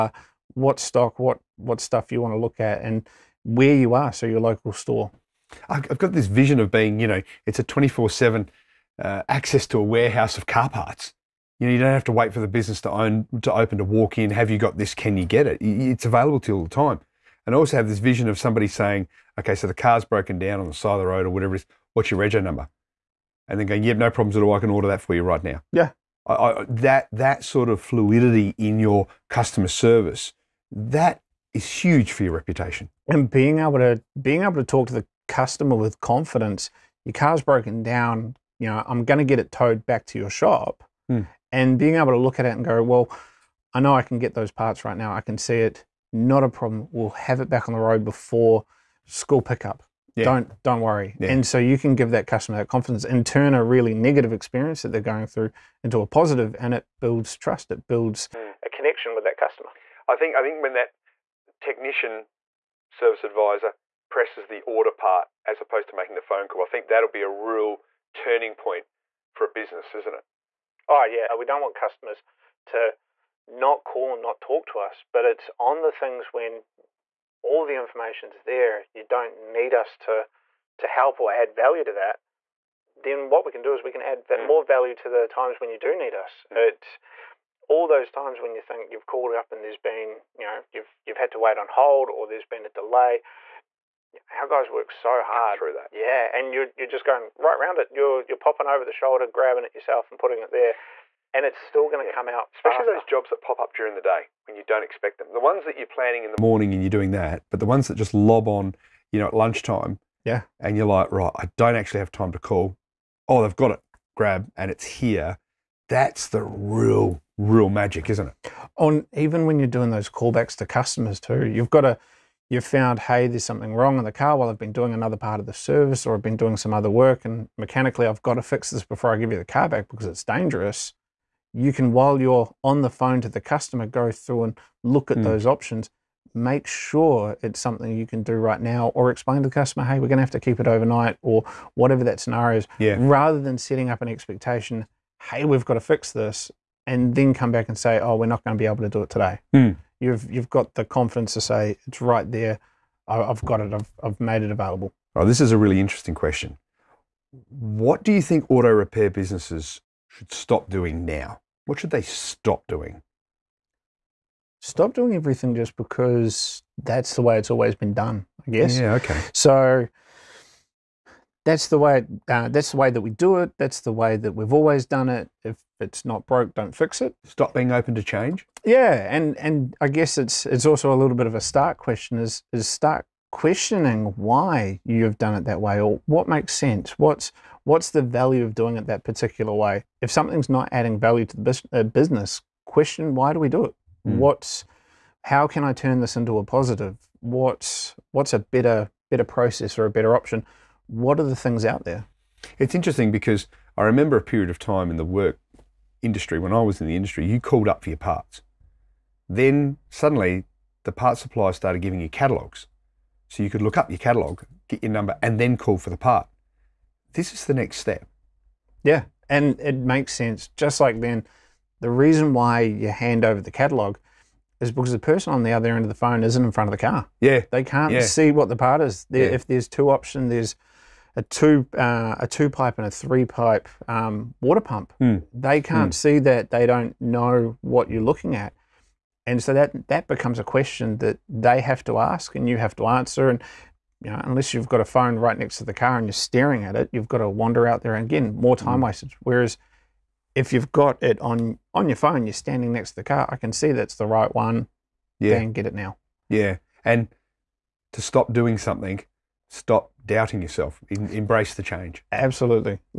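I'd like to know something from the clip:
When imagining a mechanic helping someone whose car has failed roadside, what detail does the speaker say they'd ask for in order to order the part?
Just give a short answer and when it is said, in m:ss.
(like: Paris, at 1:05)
Rego number, at 0:22.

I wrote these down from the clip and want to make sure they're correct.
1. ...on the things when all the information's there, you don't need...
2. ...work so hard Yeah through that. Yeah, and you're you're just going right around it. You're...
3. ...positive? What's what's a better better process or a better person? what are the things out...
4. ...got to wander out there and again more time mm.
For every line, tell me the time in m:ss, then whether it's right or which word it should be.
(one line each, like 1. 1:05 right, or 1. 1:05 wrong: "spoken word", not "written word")
1. 1:15 right
2. 1:34 wrong: "Cut", not "Yeah"
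3. 3:16 wrong: "option", not "person"
4. 4:07 right.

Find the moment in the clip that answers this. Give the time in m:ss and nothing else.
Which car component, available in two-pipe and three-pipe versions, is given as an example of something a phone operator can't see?
3:54.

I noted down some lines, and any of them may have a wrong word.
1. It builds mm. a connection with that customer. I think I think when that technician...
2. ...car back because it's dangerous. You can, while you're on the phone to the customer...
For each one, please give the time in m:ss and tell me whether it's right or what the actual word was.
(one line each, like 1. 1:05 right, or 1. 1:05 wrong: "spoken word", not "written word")
1. 0:57 right
2. 2:09 right.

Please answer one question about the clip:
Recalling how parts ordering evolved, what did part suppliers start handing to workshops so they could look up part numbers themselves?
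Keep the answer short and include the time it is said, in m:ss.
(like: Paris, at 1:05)
Catalogs, at 3:32.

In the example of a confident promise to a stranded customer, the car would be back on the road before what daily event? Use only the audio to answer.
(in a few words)
School pickup.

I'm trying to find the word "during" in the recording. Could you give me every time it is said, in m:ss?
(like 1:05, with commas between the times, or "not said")
1:43.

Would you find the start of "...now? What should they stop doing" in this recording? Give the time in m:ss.
2:41.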